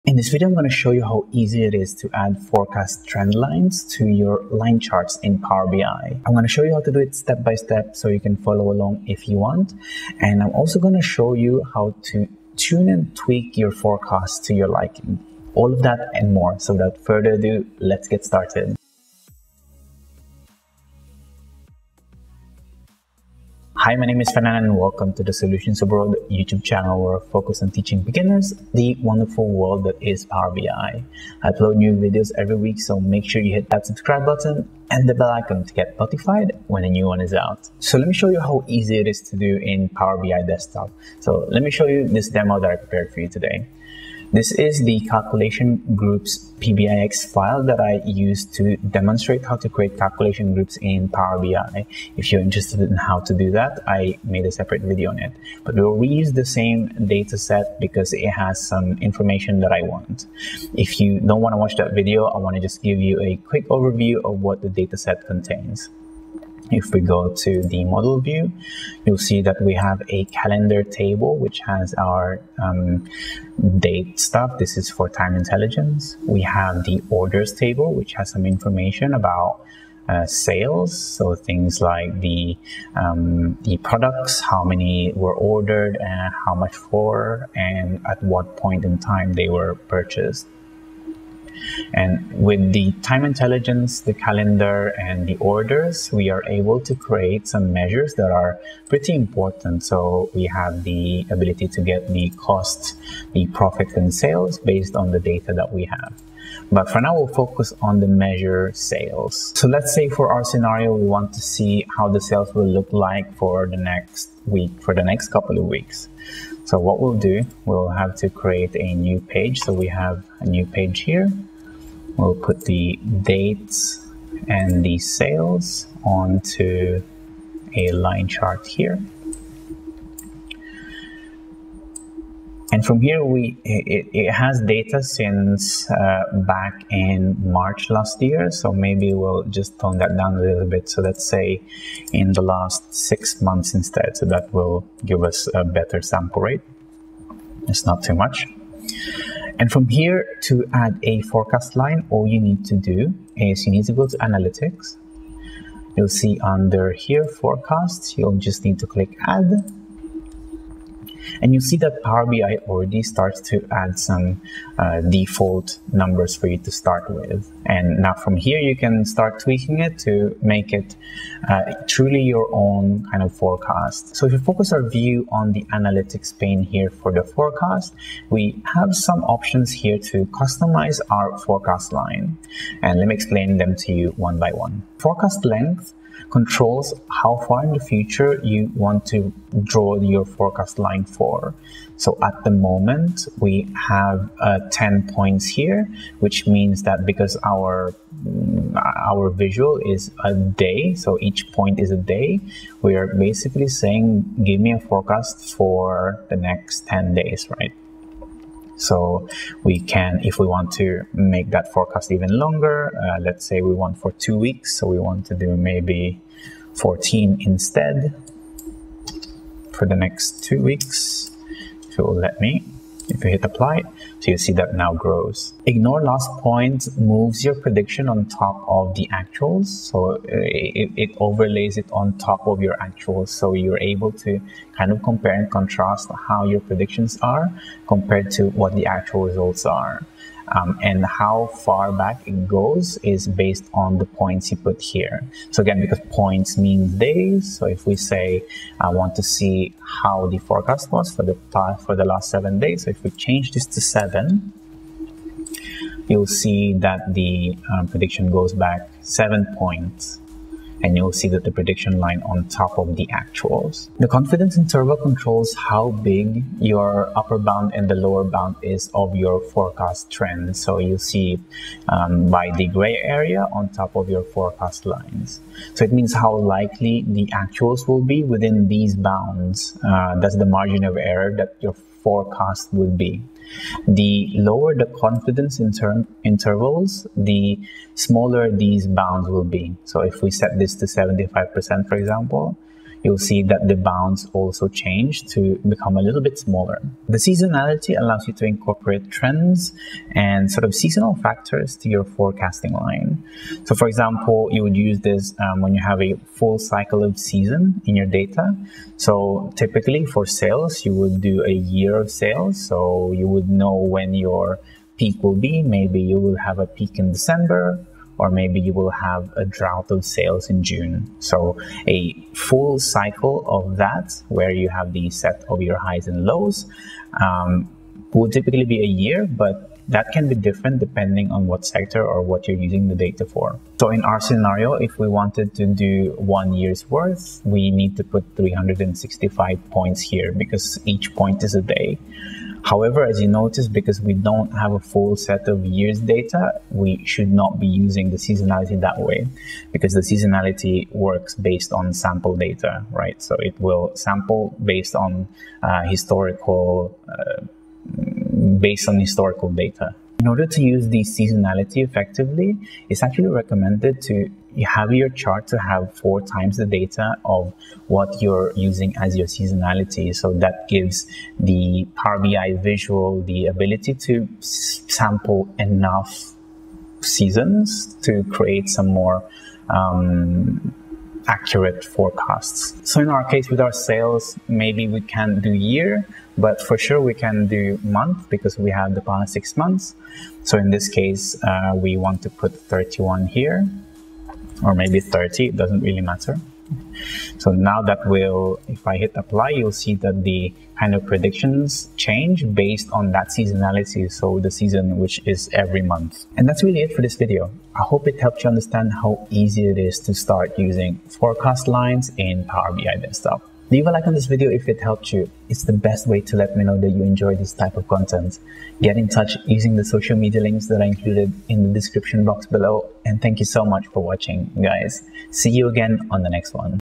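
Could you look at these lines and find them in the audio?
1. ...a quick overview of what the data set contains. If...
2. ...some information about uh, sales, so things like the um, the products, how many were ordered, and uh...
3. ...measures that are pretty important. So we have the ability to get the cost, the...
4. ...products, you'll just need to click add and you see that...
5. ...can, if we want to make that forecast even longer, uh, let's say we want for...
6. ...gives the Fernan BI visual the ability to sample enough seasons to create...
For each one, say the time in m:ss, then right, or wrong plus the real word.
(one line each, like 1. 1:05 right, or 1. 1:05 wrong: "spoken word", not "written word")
1. 1:03 right
2. 1:18 right
3. 1:37 right
4. 2:37 wrong: "forecasts", not "products"
5. 3:29 right
6. 6:10 wrong: "Power", not "Fernan".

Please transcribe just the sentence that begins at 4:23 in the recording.
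The confidence interval controls how big your upper bound and the lower bound is of your forecast trend.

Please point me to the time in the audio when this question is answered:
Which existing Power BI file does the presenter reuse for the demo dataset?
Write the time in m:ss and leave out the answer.
0:45.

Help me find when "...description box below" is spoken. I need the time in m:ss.
7:01.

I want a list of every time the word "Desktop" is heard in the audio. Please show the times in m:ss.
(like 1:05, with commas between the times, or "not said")
0:40, 6:53.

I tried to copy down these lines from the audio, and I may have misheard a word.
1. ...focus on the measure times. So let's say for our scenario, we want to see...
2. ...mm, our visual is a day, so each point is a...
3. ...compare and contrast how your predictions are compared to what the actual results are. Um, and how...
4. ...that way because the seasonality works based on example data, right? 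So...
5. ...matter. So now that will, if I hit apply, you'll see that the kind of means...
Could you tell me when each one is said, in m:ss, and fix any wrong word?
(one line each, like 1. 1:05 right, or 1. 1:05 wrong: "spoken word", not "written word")
1. 1:47 wrong: "sales", not "times"
2. 3:18 right
3. 3:55 right
4. 5:48 wrong: "sample", not "example"
5. 6:36 wrong: "predictions", not "means".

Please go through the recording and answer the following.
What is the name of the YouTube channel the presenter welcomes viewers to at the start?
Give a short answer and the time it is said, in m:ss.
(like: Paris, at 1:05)
Solutions Abroad, at 0:25.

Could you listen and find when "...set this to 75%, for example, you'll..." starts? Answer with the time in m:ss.
4:50.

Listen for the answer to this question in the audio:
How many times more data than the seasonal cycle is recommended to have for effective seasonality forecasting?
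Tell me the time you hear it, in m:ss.
6:05.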